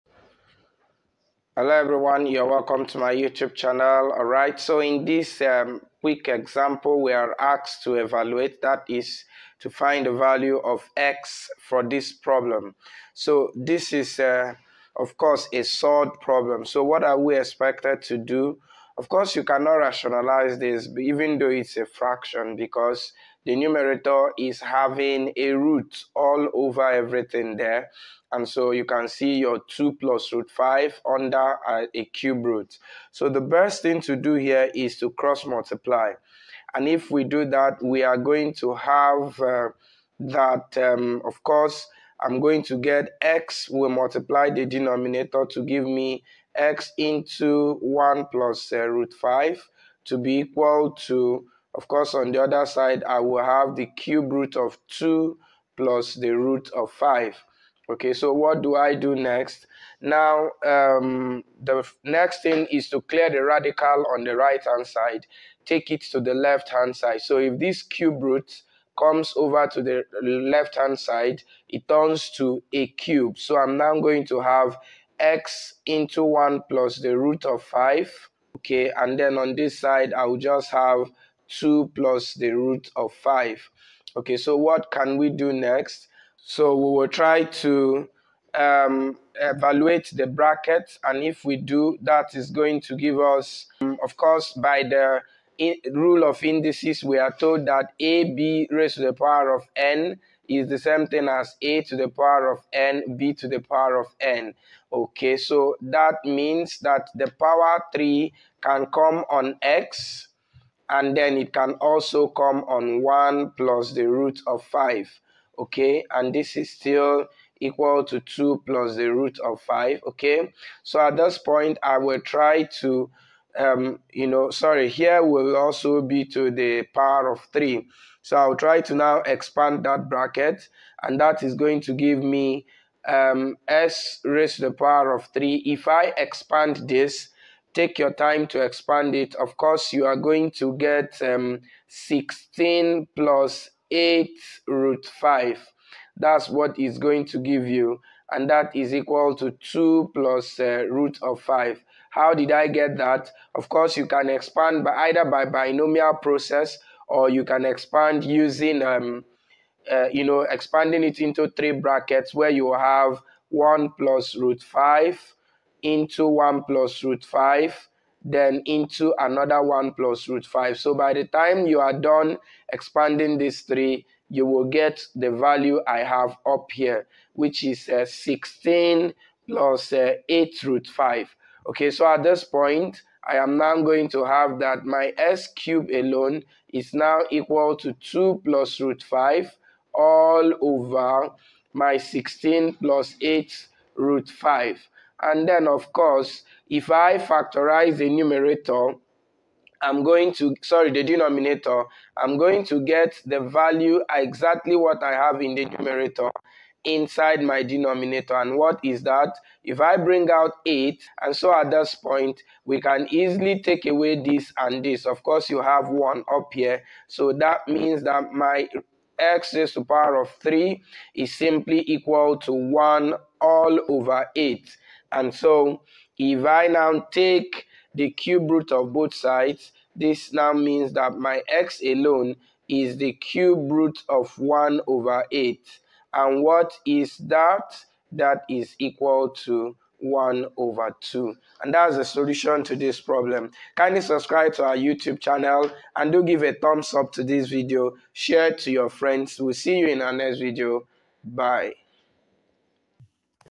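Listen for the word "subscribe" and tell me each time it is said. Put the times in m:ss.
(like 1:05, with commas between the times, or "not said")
4:04.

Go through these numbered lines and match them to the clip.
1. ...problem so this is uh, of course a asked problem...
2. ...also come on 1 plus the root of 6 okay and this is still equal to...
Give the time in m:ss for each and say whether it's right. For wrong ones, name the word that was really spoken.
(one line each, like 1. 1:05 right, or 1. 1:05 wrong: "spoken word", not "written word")
1. 0:12 wrong: "solved", not "asked"
2. 1:51 wrong: "5", not "6".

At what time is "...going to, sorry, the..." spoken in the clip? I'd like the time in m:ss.
3:20.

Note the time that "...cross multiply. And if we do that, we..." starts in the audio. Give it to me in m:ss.
0:35.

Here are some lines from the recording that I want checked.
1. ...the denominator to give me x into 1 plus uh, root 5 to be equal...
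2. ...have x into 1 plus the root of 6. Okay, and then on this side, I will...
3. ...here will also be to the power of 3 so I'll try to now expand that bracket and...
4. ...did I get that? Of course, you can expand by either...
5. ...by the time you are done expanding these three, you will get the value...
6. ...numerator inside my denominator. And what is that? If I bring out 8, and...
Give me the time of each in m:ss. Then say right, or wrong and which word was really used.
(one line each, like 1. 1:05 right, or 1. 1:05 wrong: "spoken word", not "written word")
1. 0:44 right
2. 1:14 wrong: "5", not "6"
3. 2:04 right
4. 2:32 right
5. 2:50 right
6. 3:25 right.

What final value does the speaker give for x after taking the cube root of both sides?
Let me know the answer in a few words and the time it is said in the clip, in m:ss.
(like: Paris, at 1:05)
1/2, at 3:59.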